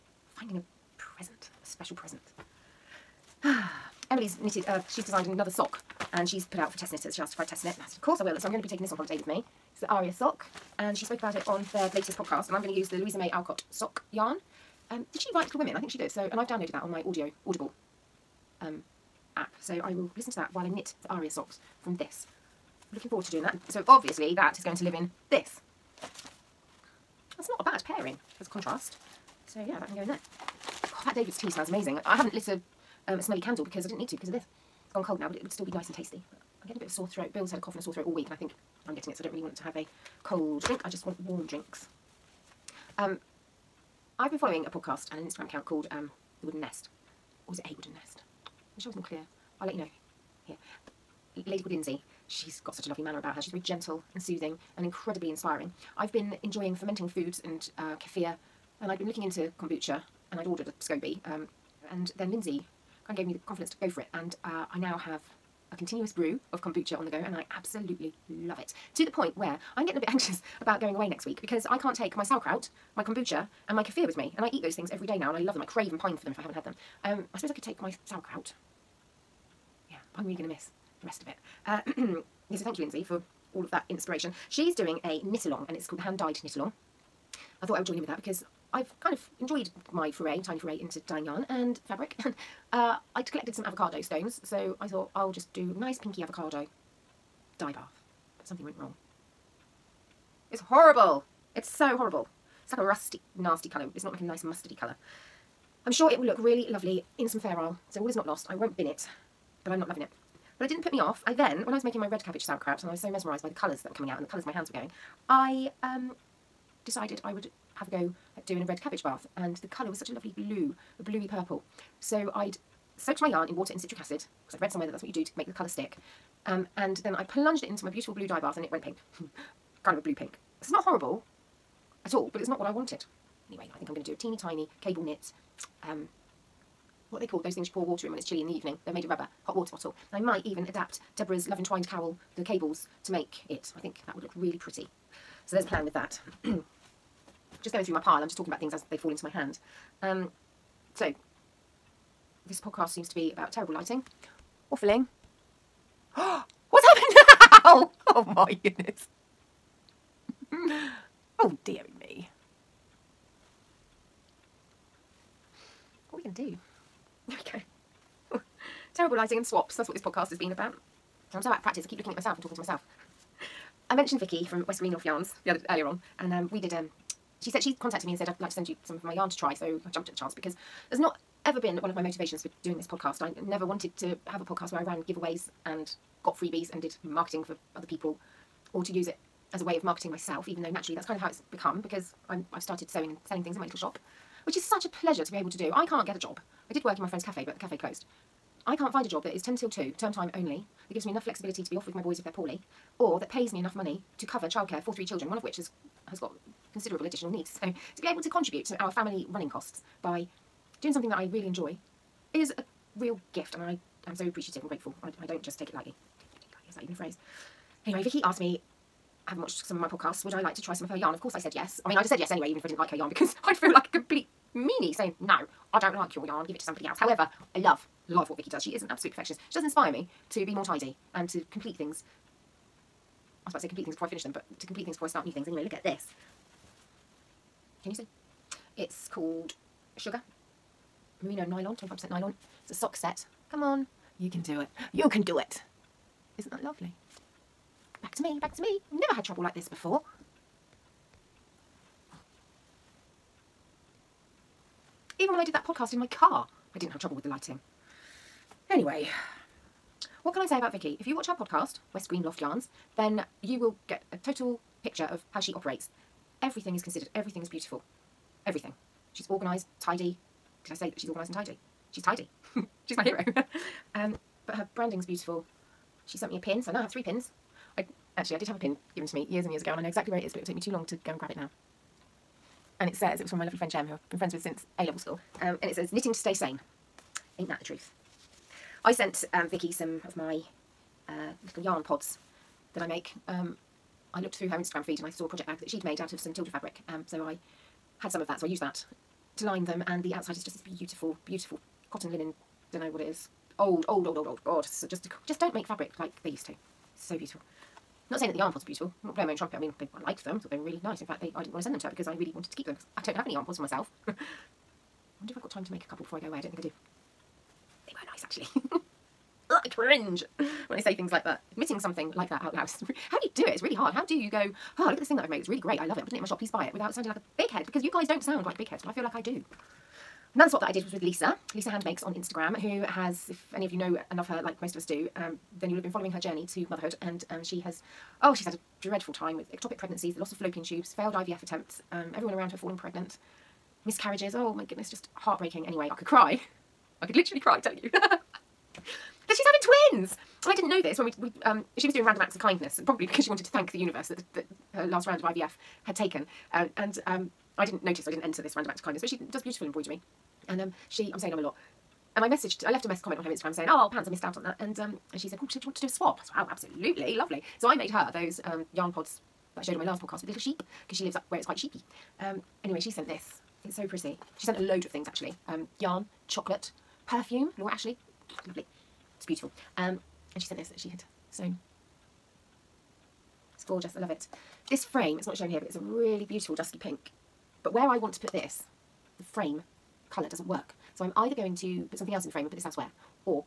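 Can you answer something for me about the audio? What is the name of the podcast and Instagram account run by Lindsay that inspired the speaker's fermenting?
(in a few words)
The Wooden Nest.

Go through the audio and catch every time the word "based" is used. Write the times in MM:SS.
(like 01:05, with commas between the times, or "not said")
not said.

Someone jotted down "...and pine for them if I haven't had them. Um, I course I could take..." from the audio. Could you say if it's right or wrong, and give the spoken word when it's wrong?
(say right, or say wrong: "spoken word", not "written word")
wrong: "suppose", not "course".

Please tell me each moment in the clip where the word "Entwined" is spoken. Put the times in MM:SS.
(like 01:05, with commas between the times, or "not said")
02:21.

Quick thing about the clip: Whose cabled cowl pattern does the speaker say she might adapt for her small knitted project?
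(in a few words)
Deborah's.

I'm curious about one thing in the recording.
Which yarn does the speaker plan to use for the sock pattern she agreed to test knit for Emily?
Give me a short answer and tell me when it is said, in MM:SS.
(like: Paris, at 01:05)
Louisa May Alcott, at 00:12.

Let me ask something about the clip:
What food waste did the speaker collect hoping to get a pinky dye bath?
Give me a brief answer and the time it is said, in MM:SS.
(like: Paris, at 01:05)
Avocado stones, at 01:33.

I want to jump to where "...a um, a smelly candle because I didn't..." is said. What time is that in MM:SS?
00:32.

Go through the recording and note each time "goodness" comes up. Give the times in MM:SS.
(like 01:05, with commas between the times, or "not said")
02:38, 05:44.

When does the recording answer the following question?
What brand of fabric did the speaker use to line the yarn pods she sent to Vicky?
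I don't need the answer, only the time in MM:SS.
04:56.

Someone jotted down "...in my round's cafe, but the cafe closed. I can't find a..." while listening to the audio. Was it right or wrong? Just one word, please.
wrong.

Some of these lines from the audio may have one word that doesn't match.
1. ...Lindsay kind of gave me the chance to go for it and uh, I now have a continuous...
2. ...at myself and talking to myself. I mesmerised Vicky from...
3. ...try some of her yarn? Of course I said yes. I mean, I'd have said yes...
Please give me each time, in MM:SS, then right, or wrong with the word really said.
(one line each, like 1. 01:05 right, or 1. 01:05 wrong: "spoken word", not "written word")
1. 01:02 wrong: "confidence", not "chance"
2. 02:52 wrong: "mentioned", not "mesmerised"
3. 03:40 right.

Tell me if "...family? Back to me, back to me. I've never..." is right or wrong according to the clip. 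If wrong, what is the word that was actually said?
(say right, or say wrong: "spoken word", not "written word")
wrong: "lovely", not "family".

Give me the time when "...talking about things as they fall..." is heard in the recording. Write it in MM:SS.
02:28.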